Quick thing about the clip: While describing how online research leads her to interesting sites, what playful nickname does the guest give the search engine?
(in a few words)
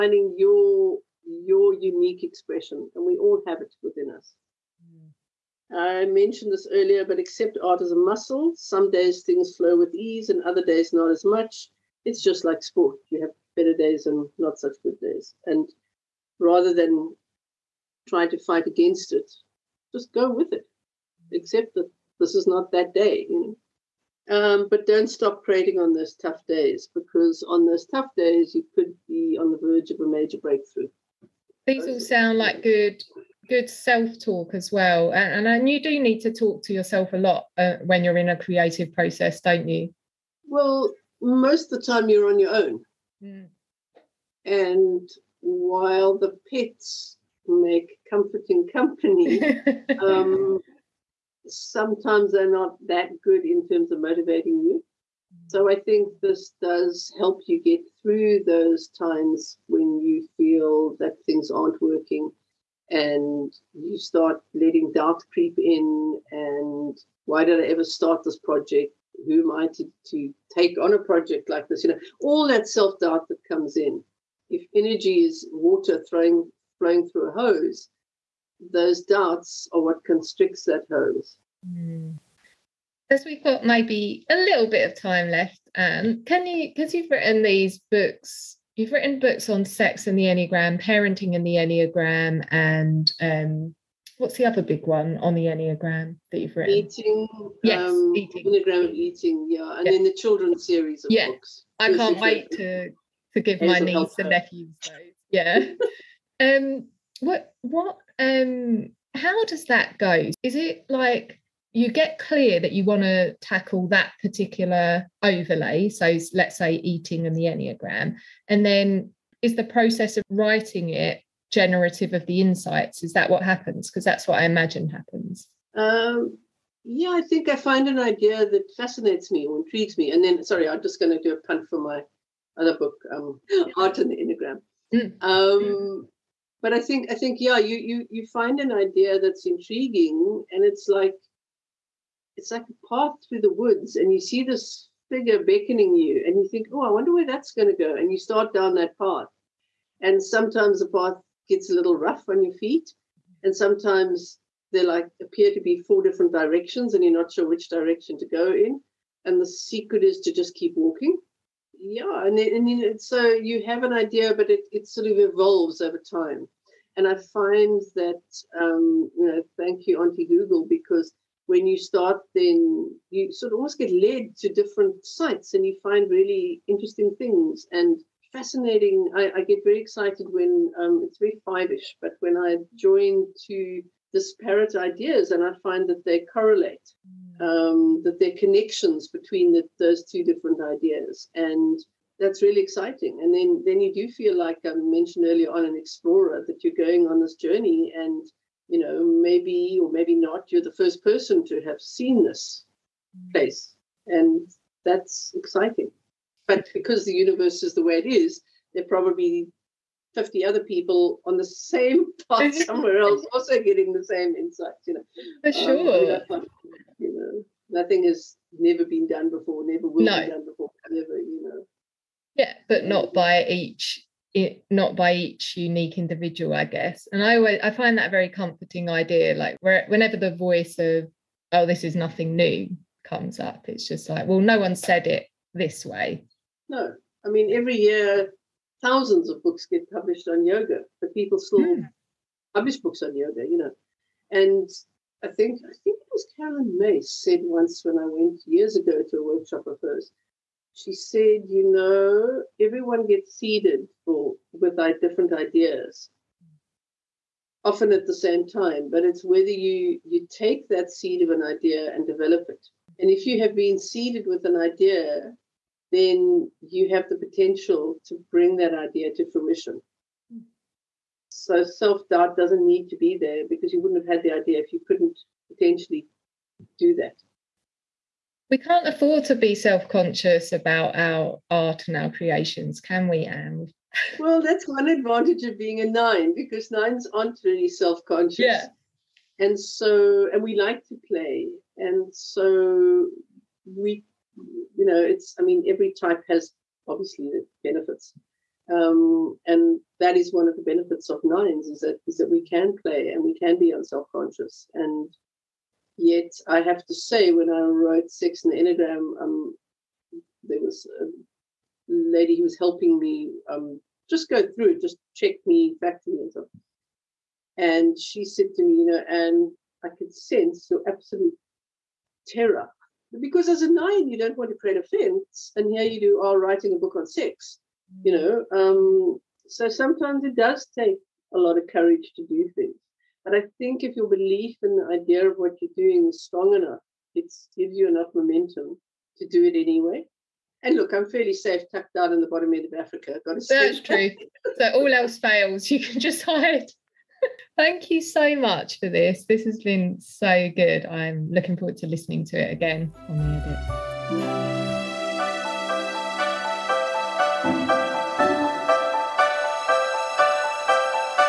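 Auntie Google.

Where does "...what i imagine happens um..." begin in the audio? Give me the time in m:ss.
2:04.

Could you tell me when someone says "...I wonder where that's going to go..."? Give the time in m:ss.
2:26.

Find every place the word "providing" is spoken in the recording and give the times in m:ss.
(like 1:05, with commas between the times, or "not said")
not said.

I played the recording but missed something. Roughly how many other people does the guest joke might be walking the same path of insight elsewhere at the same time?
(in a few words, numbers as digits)
50.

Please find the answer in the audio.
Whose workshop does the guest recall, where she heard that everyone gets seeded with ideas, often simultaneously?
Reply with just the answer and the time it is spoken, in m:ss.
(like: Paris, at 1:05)
Carolyn Myss, at 4:06.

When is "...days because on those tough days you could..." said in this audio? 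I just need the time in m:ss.
0:26.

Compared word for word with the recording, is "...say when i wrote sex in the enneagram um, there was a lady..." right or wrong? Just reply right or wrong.
right.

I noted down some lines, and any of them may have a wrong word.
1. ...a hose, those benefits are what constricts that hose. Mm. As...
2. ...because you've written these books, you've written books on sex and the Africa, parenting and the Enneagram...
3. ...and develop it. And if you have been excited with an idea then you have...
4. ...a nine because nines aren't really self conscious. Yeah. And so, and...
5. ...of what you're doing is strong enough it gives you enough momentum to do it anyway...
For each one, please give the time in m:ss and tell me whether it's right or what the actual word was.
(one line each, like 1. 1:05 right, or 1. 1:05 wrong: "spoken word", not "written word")
1. 1:17 wrong: "doubts", not "benefits"
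2. 1:26 wrong: "Enneagram", not "Africa"
3. 4:21 wrong: "seeded", not "excited"
4. 4:45 right
5. 5:35 right.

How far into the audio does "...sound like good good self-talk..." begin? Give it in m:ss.
0:31.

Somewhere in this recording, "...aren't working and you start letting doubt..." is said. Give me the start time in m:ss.
1:01.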